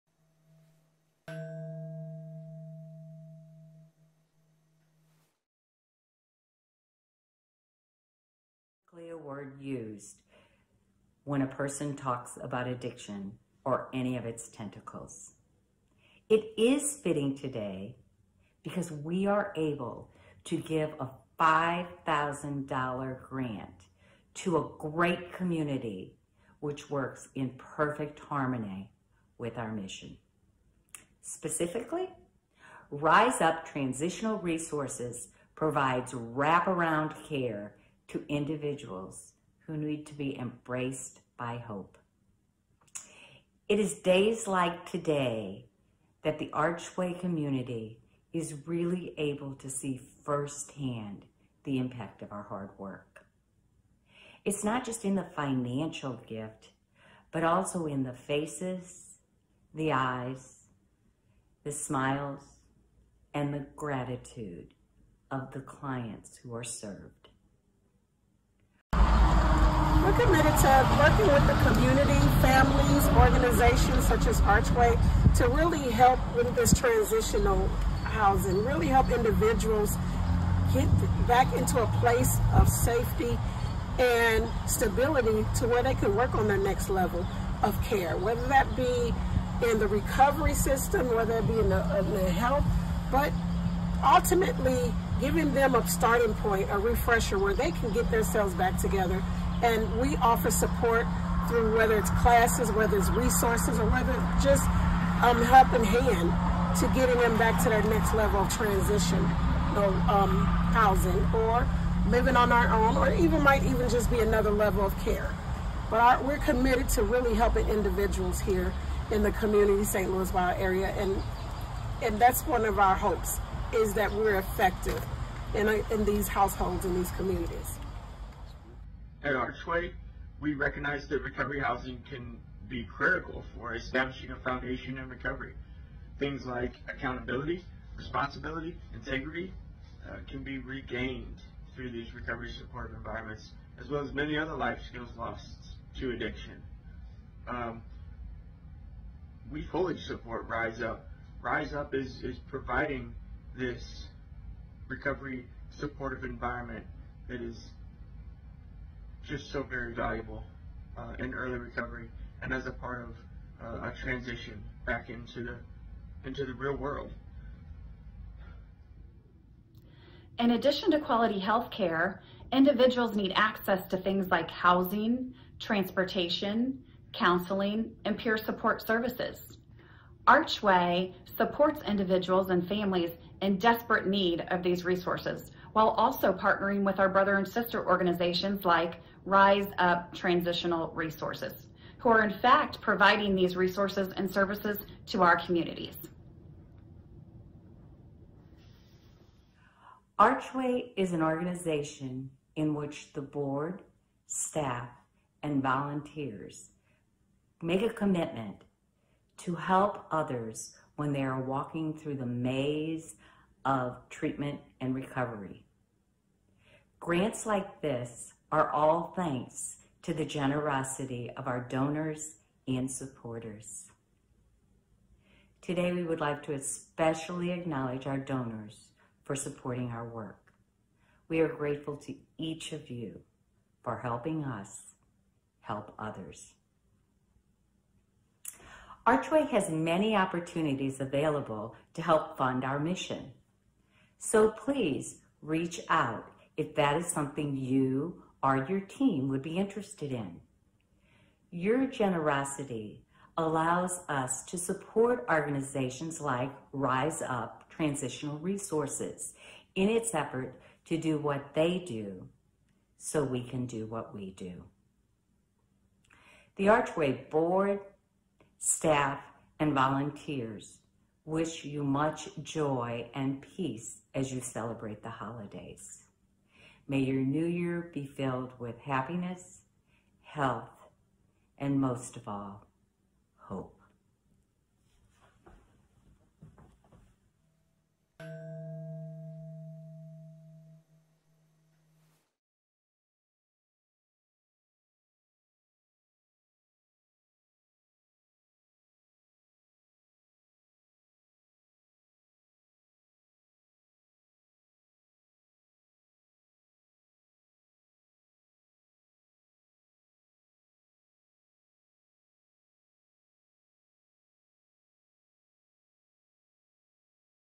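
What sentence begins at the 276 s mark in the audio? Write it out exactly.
May your new year be filled with happiness, health, and most of all, hope.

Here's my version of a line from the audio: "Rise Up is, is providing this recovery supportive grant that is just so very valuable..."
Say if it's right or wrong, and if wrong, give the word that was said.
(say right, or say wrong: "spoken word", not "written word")
wrong: "environment", not "grant".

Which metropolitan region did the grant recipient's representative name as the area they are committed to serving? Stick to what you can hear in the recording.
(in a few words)
St. Louis.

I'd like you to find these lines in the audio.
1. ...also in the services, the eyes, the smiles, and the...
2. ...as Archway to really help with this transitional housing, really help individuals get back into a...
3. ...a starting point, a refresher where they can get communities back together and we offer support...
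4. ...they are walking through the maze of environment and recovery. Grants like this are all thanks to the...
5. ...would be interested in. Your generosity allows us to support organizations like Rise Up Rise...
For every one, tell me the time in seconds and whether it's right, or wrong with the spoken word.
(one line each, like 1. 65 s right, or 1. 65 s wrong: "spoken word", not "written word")
1. 57 s wrong: "faces", not "services"
2. 74 s right
3. 95 s wrong: "themselves", not "communities"
4. 211 s wrong: "treatment", not "environment"
5. 249 s wrong: "Transitional", not "Rise".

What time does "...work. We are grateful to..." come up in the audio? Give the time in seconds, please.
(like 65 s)
230 s.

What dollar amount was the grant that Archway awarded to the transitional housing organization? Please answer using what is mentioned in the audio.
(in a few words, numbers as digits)
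$5,000.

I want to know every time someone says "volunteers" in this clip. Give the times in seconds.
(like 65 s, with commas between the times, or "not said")
205 s, 269 s.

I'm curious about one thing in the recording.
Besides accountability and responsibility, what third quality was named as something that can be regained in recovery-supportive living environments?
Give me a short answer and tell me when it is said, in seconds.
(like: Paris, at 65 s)
Integrity, at 138 s.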